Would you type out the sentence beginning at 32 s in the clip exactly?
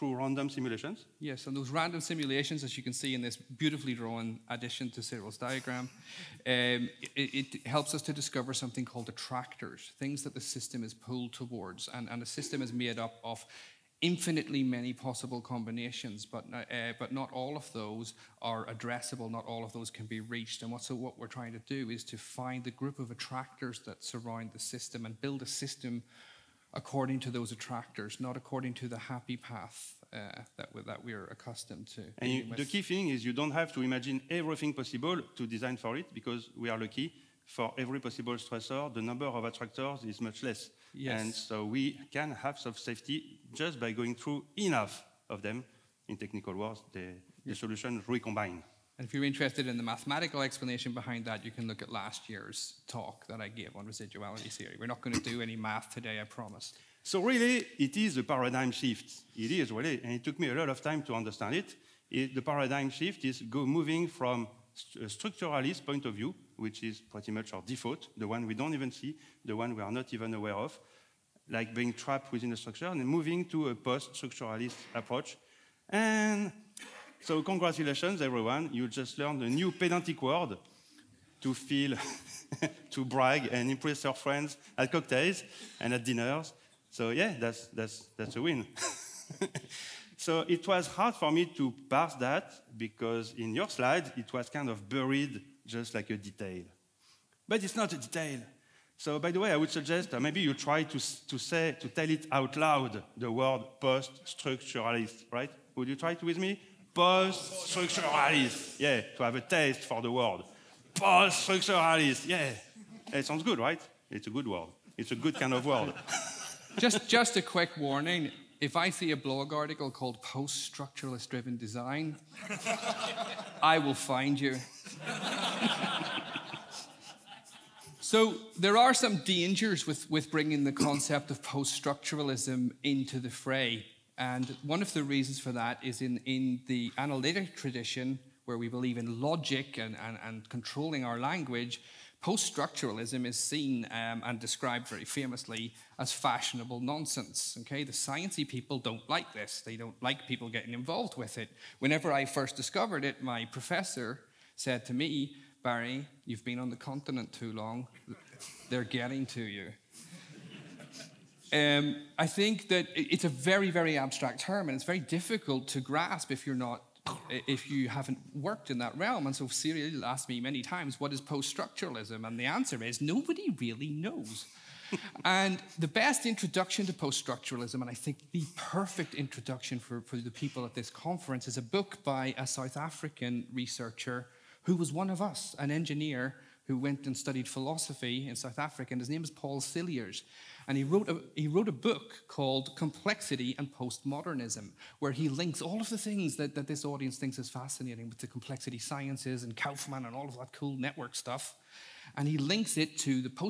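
And you, the key thing is you don't have to imagine everything possible to design for it because we are lucky.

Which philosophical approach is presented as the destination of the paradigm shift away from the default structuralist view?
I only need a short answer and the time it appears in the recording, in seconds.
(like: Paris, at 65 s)
Post-structuralist approach, at 73 s.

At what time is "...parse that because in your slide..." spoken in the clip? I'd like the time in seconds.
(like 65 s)
91 s.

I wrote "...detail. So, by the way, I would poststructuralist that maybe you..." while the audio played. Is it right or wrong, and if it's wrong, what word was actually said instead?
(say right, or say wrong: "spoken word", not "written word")
wrong: "suggest", not "poststructuralist".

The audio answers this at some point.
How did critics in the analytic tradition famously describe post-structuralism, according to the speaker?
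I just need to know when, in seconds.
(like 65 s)
146 s.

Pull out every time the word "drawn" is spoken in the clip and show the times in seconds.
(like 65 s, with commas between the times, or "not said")
3 s.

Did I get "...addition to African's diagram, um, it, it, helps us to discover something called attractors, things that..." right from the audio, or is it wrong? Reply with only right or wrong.
wrong.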